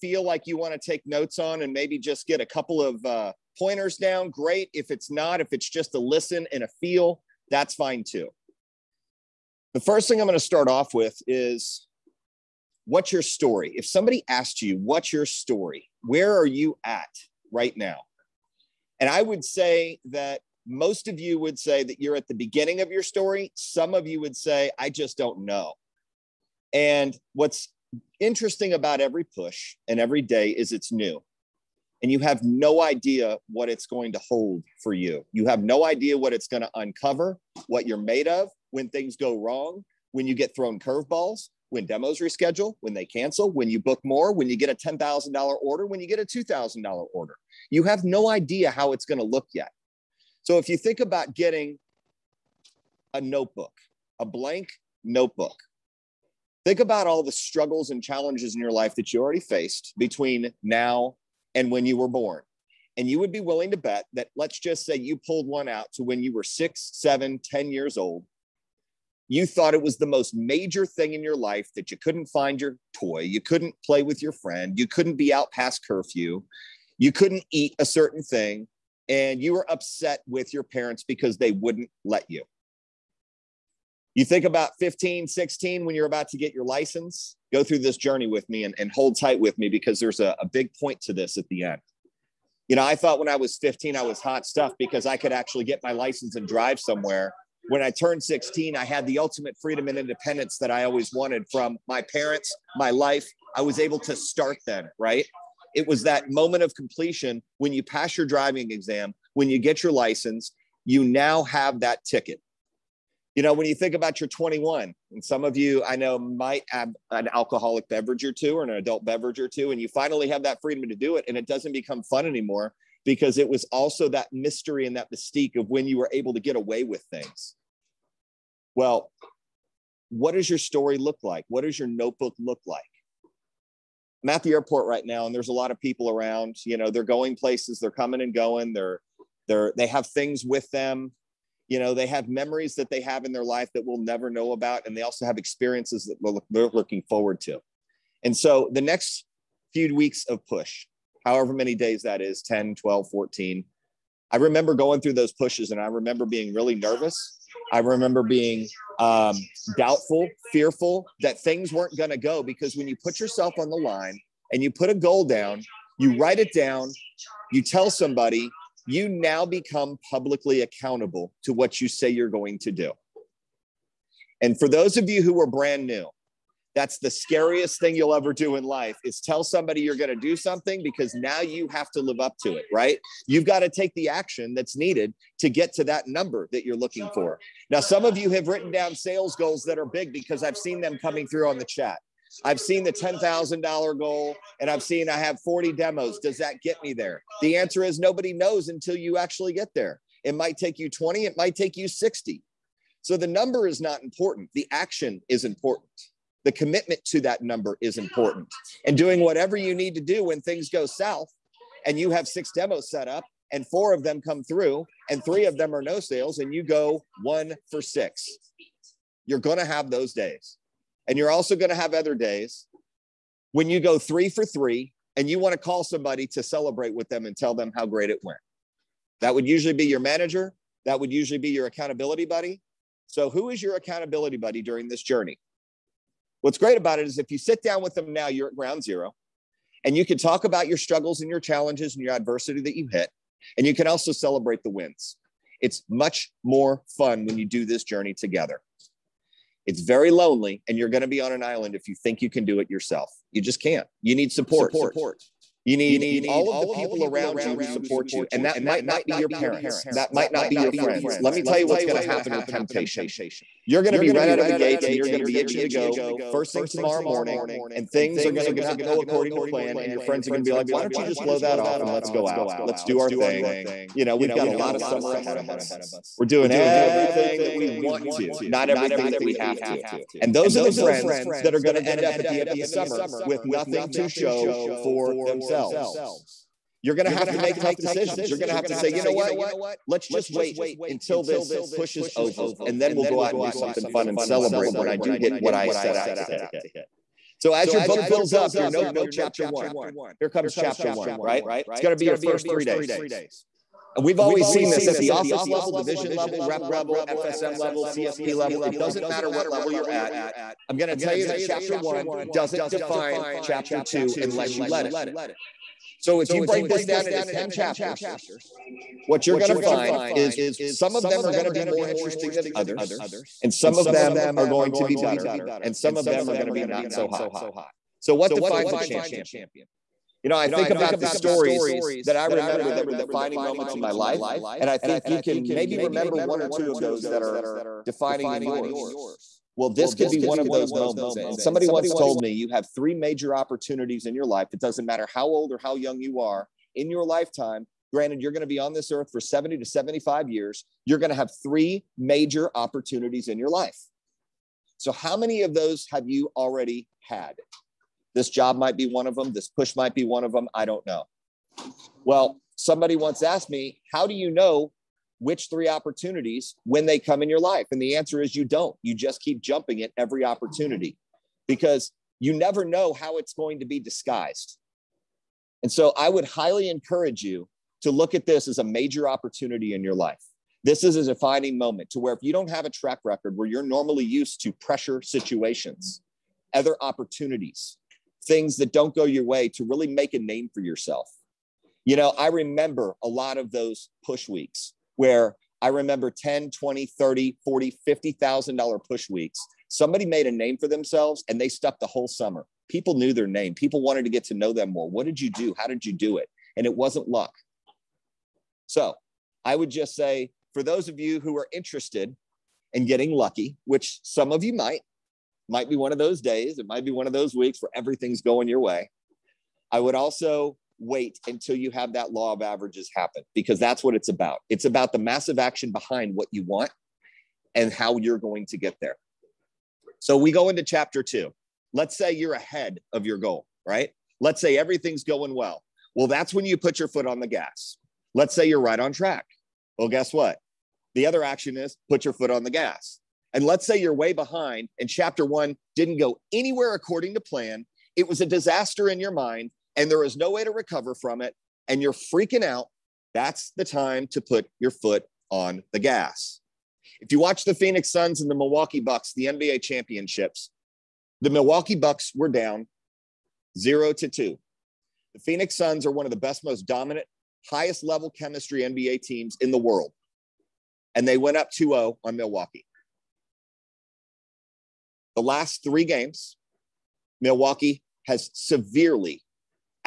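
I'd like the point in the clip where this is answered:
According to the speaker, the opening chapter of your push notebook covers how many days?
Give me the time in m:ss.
5:02.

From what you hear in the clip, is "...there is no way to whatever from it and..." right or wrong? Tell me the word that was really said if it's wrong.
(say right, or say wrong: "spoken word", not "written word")
wrong: "recover", not "whatever".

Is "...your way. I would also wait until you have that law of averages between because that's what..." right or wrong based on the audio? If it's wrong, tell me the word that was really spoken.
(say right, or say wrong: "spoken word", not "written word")
wrong: "happen", not "between".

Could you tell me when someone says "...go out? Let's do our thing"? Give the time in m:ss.
4:32.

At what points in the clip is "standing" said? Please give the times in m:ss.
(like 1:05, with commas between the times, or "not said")
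not said.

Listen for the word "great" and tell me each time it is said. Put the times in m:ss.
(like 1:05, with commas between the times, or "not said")
0:04, 3:47, 3:56.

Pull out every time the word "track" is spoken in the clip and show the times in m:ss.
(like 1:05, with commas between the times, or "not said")
6:22, 7:18.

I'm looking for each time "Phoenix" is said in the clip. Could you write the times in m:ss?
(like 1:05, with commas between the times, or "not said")
7:37, 7:45.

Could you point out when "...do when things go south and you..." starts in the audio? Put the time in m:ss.
3:30.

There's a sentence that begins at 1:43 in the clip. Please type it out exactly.
I was able to start then, right?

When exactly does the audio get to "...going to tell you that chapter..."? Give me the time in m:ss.
5:10.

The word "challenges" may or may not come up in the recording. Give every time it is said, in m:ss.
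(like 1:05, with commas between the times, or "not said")
0:58, 4:01.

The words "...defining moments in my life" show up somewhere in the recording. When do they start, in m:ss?
5:32.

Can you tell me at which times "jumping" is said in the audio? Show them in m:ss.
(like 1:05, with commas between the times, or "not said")
6:09.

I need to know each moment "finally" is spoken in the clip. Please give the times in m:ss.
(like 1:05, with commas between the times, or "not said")
1:59.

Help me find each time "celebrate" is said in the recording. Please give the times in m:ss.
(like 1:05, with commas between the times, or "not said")
3:46, 4:04, 4:54.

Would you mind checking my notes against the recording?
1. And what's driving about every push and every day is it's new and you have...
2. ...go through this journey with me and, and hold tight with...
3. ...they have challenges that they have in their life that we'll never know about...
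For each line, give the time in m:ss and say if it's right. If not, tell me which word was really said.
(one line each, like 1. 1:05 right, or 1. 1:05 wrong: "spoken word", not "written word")
1. 0:26 wrong: "interesting", not "driving"
2. 1:27 right
3. 2:21 wrong: "memories", not "challenges".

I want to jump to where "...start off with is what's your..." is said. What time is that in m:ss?
0:10.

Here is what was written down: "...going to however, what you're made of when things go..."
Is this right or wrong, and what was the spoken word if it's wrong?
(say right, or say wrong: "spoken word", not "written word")
wrong: "uncover", not "however".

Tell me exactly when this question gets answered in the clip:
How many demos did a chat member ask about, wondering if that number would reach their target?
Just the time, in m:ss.
3:15.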